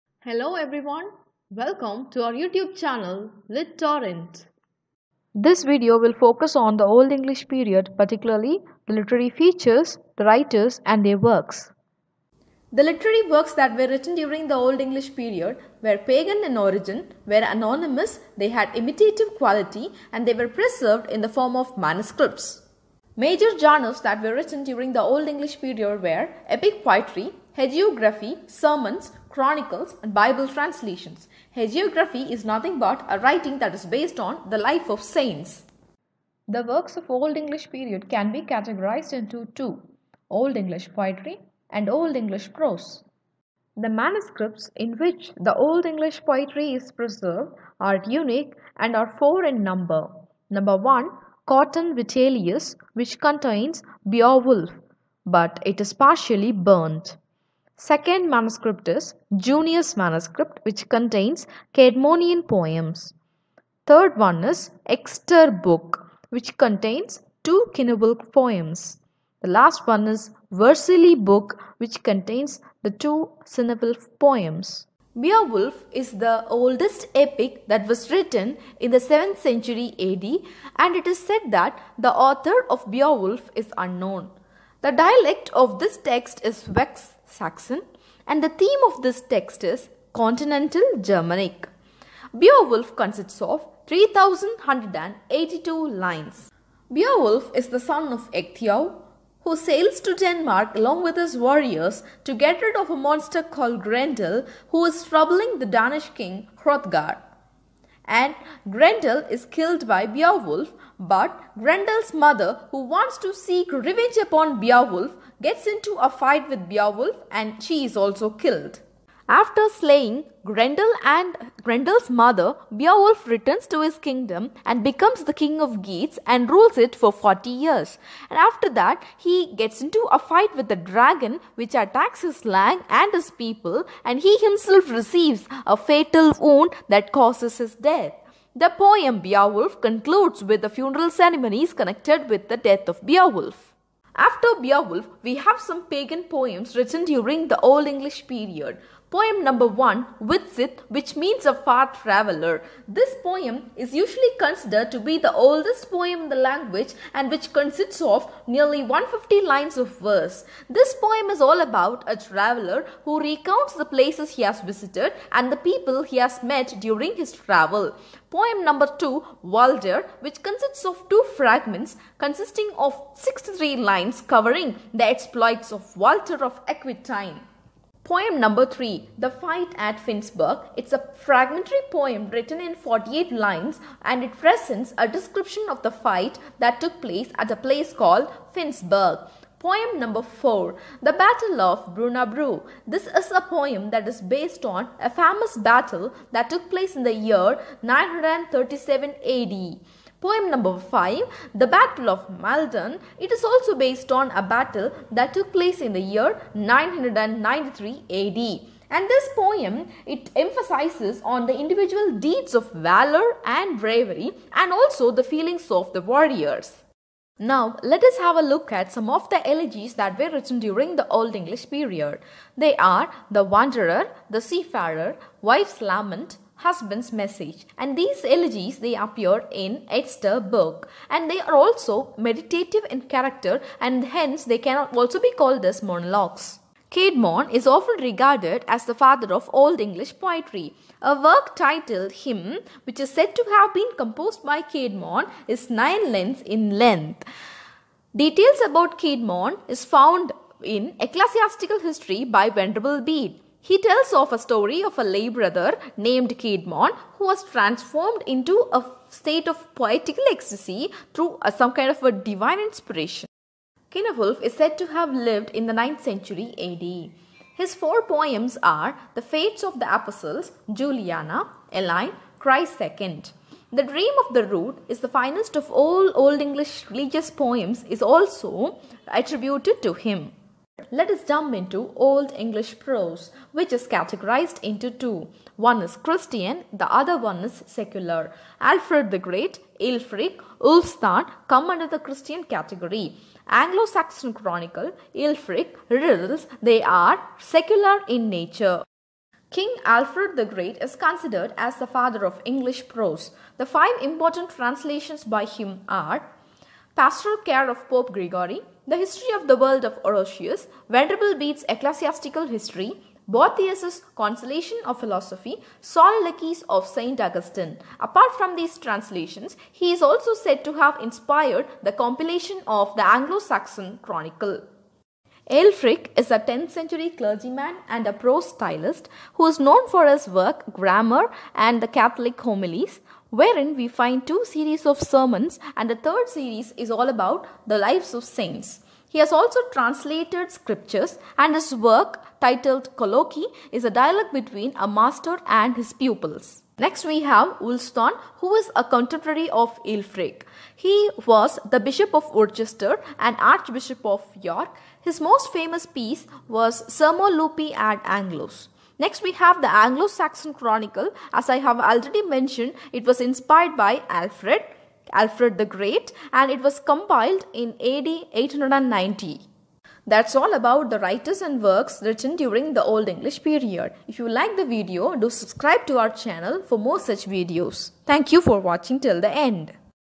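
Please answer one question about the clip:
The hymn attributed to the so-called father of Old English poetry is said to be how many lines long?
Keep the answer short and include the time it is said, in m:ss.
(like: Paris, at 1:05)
Nine, at 4:05.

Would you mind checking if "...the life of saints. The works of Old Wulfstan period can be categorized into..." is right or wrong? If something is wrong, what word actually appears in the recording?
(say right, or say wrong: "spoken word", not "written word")
wrong: "English", not "Wulfstan".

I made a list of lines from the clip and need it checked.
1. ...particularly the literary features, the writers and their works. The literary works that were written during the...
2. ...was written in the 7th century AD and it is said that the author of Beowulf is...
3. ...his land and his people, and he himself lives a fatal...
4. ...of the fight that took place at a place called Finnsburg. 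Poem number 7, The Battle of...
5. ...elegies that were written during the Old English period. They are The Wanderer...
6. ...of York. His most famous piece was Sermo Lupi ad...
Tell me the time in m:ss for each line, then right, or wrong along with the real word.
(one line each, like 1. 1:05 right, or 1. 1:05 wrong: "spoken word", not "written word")
1. 0:07 right
2. 1:17 right
3. 2:12 wrong: "receives", not "lives"
4. 3:05 wrong: "4", not "7"
5. 3:39 right
6. 5:54 right.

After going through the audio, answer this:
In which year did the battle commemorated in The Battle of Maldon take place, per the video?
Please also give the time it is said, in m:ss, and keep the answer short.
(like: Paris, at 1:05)
993 AD, at 3:26.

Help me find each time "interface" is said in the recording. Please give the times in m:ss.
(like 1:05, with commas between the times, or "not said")
not said.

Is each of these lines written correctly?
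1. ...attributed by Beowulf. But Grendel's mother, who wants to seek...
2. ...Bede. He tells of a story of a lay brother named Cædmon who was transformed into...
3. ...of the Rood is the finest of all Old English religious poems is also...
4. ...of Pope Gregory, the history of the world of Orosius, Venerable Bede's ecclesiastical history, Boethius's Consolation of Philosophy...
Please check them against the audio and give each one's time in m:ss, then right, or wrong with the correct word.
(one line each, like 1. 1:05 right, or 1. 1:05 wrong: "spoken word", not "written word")
1. 1:49 wrong: "killed", not "attributed"
2. 4:12 right
3. 4:34 right
4. 5:07 right.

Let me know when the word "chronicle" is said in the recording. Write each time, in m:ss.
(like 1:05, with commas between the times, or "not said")
0:29, 4:54, 5:24, 6:00.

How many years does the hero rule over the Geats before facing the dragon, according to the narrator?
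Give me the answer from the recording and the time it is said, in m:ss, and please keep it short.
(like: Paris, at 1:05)
40, at 2:07.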